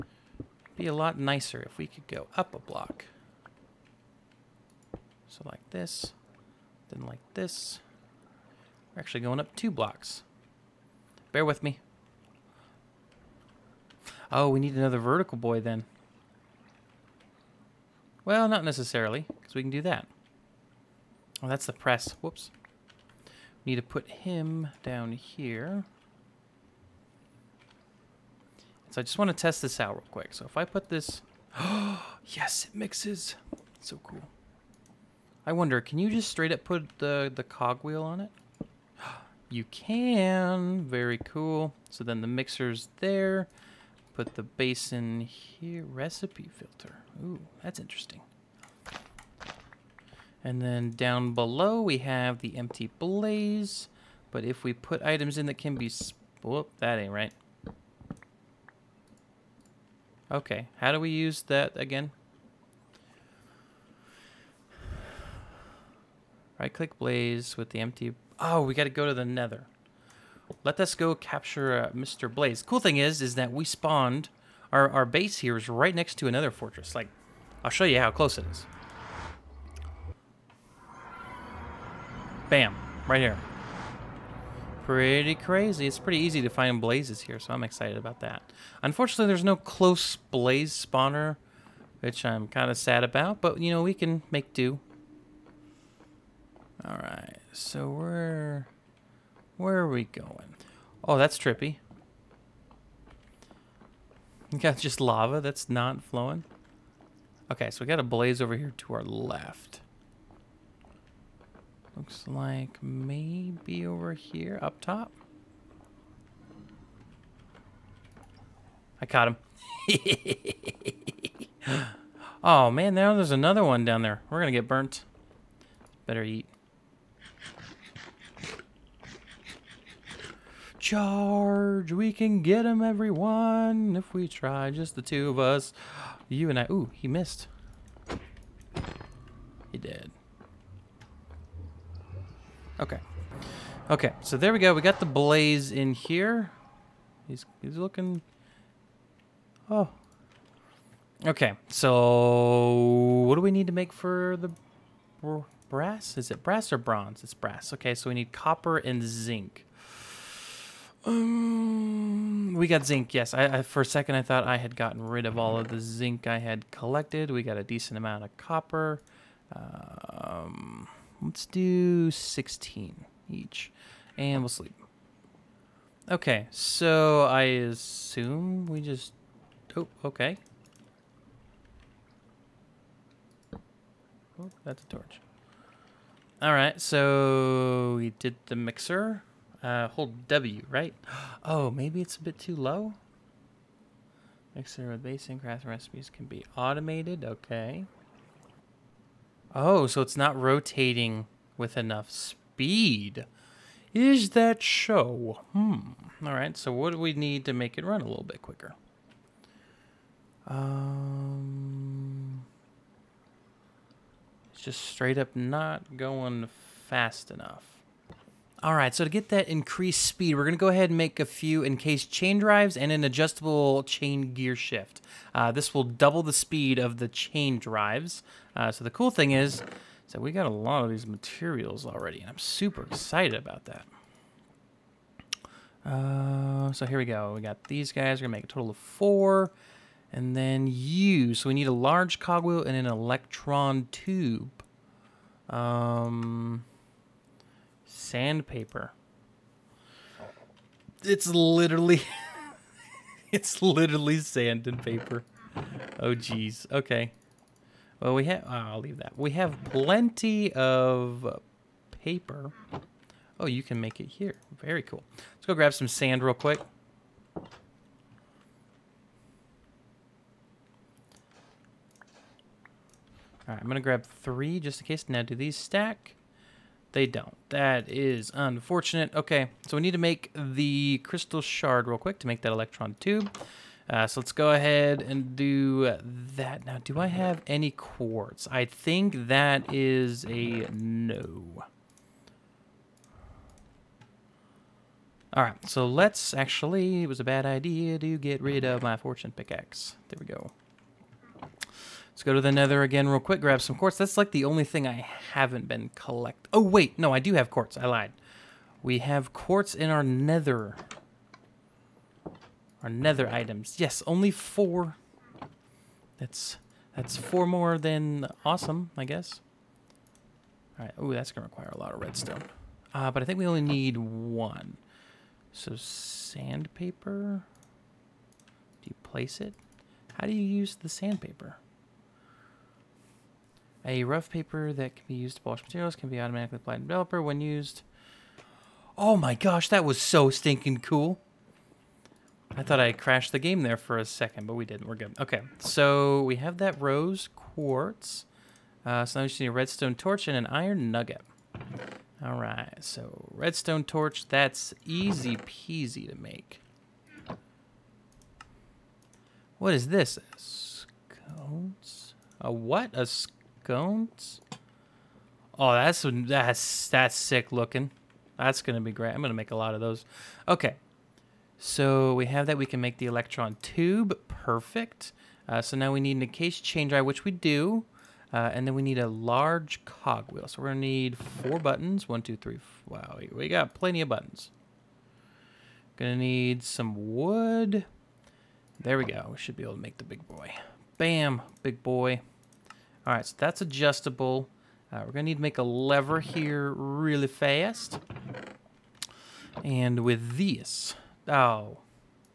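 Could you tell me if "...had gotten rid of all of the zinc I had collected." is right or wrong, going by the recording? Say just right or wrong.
right.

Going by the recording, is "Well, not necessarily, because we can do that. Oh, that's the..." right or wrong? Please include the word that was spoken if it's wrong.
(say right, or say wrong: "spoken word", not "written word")
right.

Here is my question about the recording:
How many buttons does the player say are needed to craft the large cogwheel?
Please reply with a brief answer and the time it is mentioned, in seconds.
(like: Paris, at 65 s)
4, at 381 s.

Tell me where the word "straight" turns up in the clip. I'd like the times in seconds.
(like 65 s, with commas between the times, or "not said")
36 s, 214 s.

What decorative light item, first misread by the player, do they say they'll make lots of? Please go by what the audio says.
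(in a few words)
sconce.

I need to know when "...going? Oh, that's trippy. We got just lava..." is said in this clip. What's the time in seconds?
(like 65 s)
100 s.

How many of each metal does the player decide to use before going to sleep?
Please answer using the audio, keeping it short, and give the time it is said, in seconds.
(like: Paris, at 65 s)
16, at 172 s.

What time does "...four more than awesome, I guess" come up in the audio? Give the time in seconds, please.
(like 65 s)
317 s.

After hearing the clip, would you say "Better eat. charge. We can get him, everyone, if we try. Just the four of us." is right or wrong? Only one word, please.
wrong.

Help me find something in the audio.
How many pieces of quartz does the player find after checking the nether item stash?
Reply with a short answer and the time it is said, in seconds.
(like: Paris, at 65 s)
4, at 314 s.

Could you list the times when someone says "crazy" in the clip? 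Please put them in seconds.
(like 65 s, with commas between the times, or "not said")
85 s.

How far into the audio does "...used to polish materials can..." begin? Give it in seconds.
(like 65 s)
335 s.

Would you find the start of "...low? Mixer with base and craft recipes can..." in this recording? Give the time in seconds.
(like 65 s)
192 s.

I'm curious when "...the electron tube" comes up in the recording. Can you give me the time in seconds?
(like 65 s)
372 s.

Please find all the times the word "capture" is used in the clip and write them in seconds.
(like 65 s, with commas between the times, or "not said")
71 s.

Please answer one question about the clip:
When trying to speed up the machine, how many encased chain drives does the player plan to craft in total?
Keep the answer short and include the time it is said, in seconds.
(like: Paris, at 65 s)
4, at 238 s.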